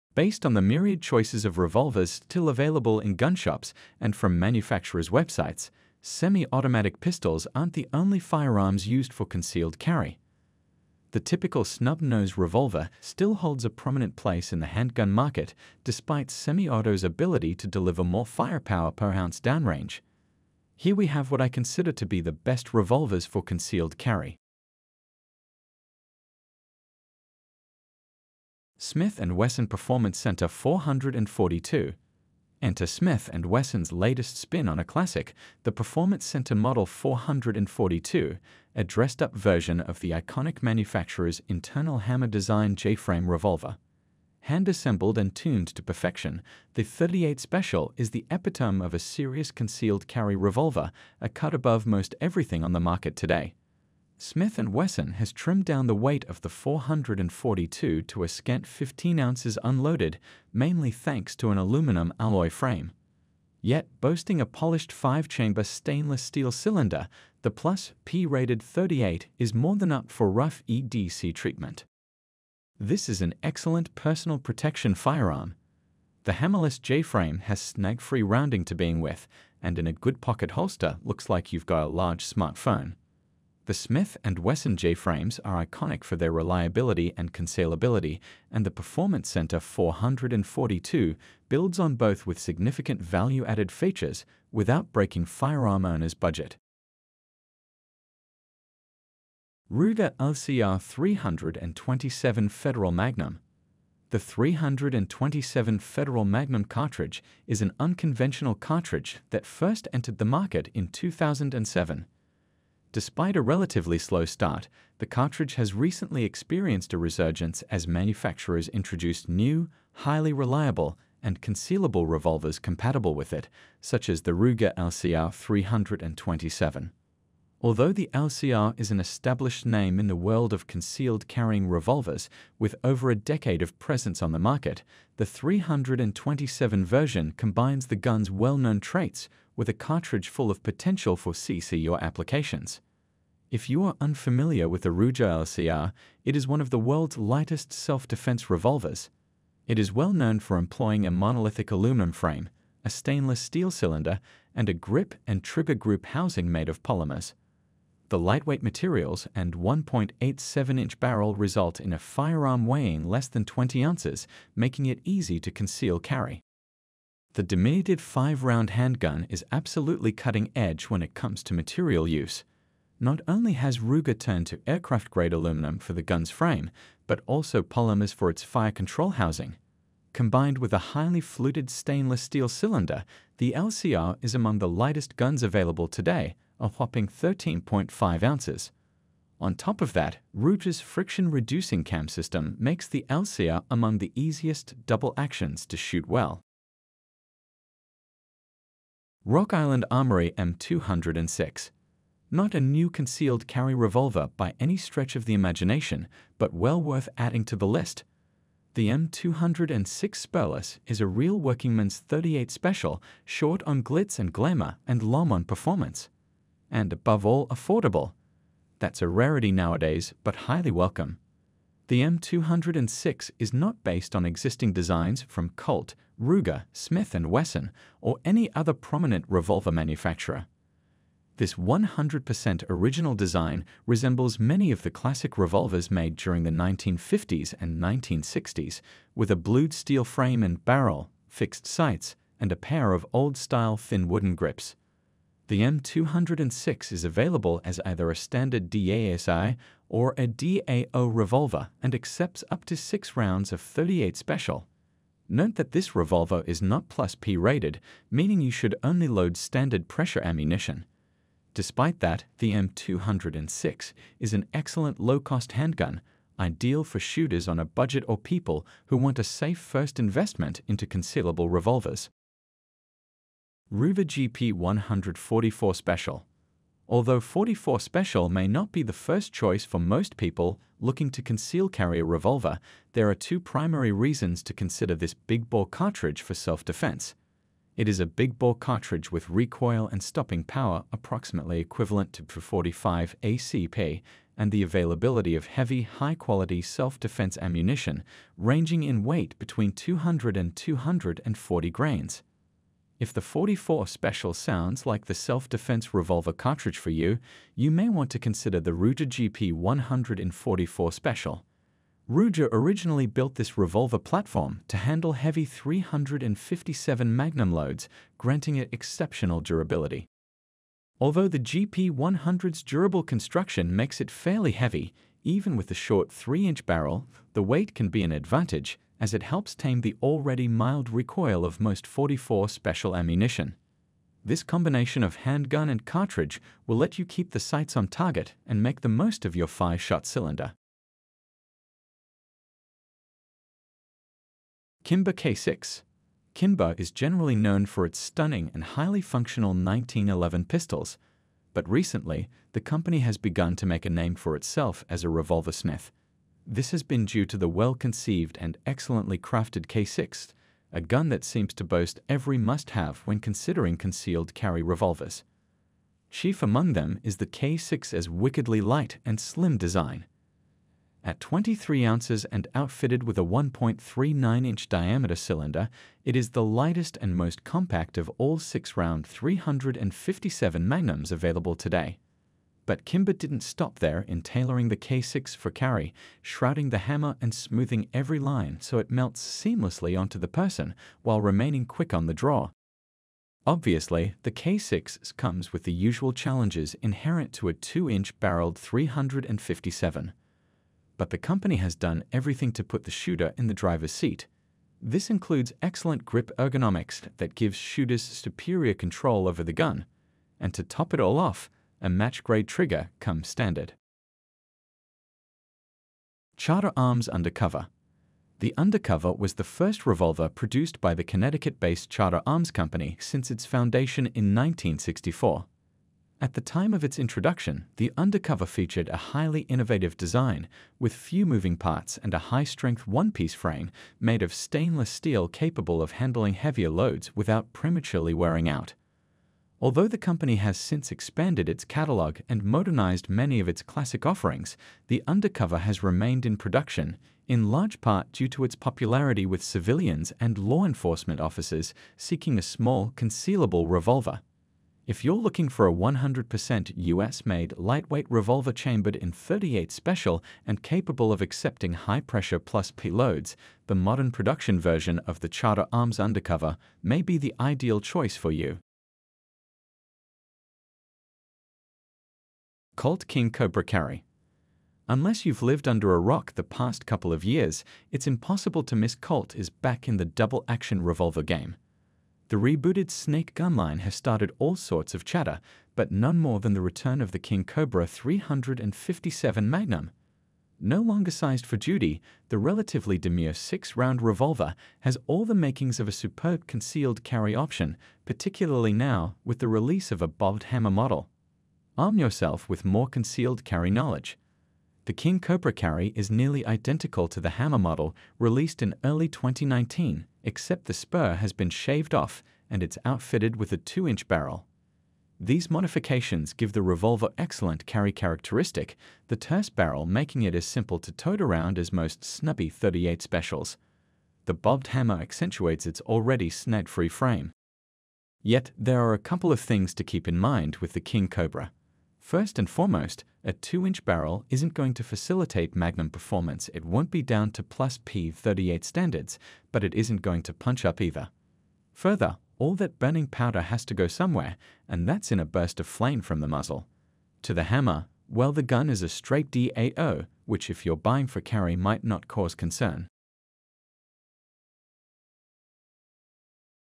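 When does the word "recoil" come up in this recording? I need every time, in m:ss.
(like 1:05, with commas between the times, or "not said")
4:49, 5:30.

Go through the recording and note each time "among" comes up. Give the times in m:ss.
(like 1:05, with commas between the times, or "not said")
3:04, 3:13, 6:06.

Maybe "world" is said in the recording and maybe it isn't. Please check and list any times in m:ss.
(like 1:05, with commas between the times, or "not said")
2:10, 2:26.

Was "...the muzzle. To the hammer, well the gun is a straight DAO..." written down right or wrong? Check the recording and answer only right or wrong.
right.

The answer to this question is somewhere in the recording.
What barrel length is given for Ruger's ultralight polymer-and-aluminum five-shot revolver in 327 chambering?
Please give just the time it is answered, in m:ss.
2:39.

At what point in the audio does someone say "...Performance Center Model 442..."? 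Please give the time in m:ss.
0:35.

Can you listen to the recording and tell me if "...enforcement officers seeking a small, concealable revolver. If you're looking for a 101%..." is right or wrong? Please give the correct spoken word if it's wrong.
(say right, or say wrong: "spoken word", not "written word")
wrong: "100", not "101".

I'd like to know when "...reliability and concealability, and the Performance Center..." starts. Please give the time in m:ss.
1:26.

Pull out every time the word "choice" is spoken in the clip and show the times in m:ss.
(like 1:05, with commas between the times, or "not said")
0:01, 4:39, 7:47.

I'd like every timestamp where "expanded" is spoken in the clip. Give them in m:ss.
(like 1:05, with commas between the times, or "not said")
7:20.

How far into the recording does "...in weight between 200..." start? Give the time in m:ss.
4:58.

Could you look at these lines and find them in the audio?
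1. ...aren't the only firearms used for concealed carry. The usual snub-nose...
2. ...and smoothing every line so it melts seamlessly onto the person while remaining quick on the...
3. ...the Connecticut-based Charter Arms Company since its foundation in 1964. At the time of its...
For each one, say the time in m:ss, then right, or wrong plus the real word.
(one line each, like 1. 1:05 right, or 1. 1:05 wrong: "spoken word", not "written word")
1. 0:07 wrong: "typical", not "usual"
2. 6:27 right
3. 7:00 right.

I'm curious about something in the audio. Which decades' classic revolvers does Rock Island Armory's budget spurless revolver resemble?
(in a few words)
1950s and 1960s.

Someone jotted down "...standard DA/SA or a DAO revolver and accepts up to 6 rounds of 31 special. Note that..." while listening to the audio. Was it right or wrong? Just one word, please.
wrong.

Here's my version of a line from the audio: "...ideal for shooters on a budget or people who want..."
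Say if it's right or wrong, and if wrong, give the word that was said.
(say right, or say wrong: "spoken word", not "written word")
right.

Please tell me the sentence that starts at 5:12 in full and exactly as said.
Ruger originally built this revolver platform to handle heavy 357 magnum loads, granting it exceptional durability.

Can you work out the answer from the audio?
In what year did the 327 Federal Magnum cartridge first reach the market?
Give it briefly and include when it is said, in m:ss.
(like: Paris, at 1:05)
2007, at 1:50.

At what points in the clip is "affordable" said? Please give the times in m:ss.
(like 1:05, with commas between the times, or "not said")
3:37.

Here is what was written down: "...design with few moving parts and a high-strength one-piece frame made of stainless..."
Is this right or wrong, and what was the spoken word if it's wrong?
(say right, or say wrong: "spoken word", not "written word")
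right.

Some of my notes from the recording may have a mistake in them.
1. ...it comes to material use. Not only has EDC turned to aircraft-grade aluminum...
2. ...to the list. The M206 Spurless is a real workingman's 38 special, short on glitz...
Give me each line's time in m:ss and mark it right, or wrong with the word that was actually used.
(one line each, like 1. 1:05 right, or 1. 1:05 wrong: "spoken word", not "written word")
1. 2:51 wrong: "Ruger", not "EDC"
2. 3:27 right.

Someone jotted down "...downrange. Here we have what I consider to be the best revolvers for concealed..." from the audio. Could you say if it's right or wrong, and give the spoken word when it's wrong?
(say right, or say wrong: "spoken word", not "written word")
right.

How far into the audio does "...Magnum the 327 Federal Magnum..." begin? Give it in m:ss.
1:42.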